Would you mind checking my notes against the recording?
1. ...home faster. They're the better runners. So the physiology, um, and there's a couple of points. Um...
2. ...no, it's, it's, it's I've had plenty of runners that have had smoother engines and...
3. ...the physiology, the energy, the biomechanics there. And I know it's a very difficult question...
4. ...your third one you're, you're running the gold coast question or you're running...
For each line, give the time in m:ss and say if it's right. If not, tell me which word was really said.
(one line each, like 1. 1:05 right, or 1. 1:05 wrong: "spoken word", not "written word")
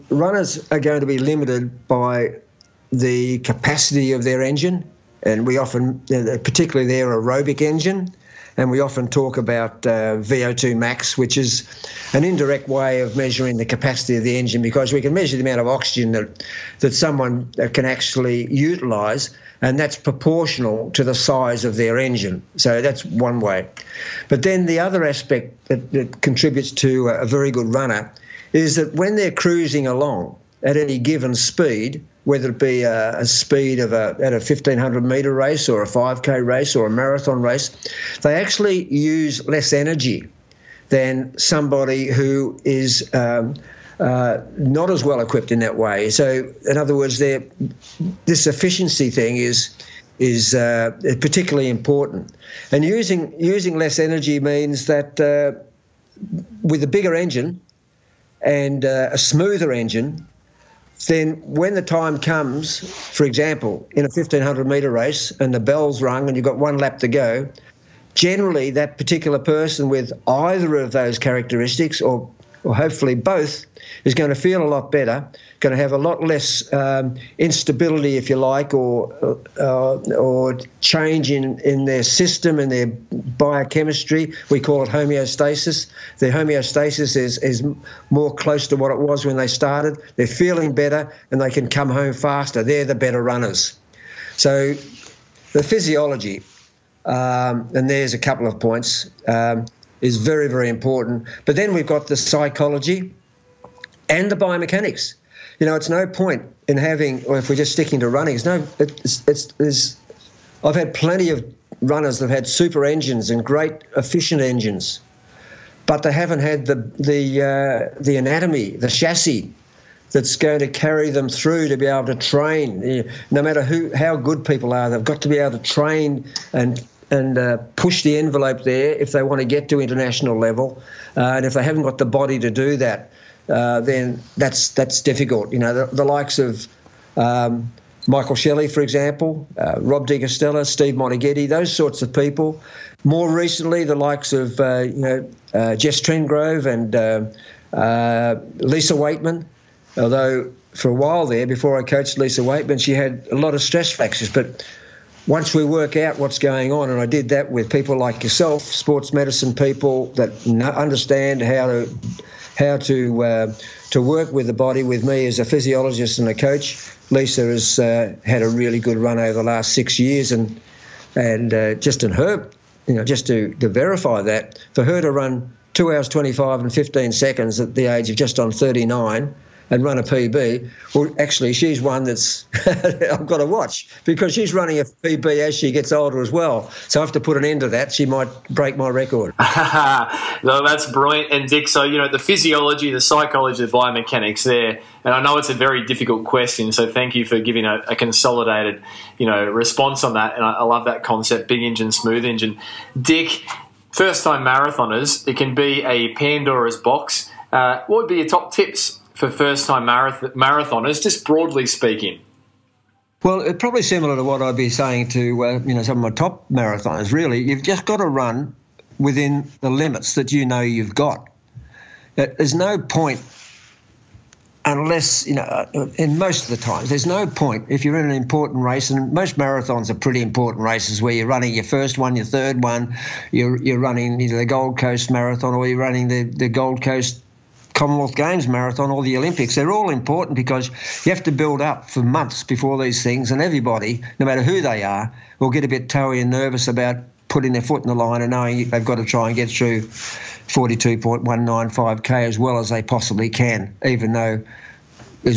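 1. 1:31 right
2. 1:48 wrong: "super", not "smoother"
3. 3:12 wrong: "psychology", not "energy"
4. 3:52 wrong: "marathon", not "question".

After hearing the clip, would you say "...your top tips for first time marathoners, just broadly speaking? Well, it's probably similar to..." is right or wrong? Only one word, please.
right.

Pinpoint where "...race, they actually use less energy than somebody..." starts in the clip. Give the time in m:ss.
0:37.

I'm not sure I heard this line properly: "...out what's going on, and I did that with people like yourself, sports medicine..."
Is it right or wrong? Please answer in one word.
right.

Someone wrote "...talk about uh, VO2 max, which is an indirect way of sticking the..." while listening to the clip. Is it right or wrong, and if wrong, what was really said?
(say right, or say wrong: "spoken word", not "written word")
wrong: "measuring", not "sticking".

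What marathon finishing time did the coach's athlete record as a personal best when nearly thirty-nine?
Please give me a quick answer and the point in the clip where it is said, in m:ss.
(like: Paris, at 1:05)
2:25:15, at 2:55.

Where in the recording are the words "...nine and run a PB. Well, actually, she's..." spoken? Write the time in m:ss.
2:58.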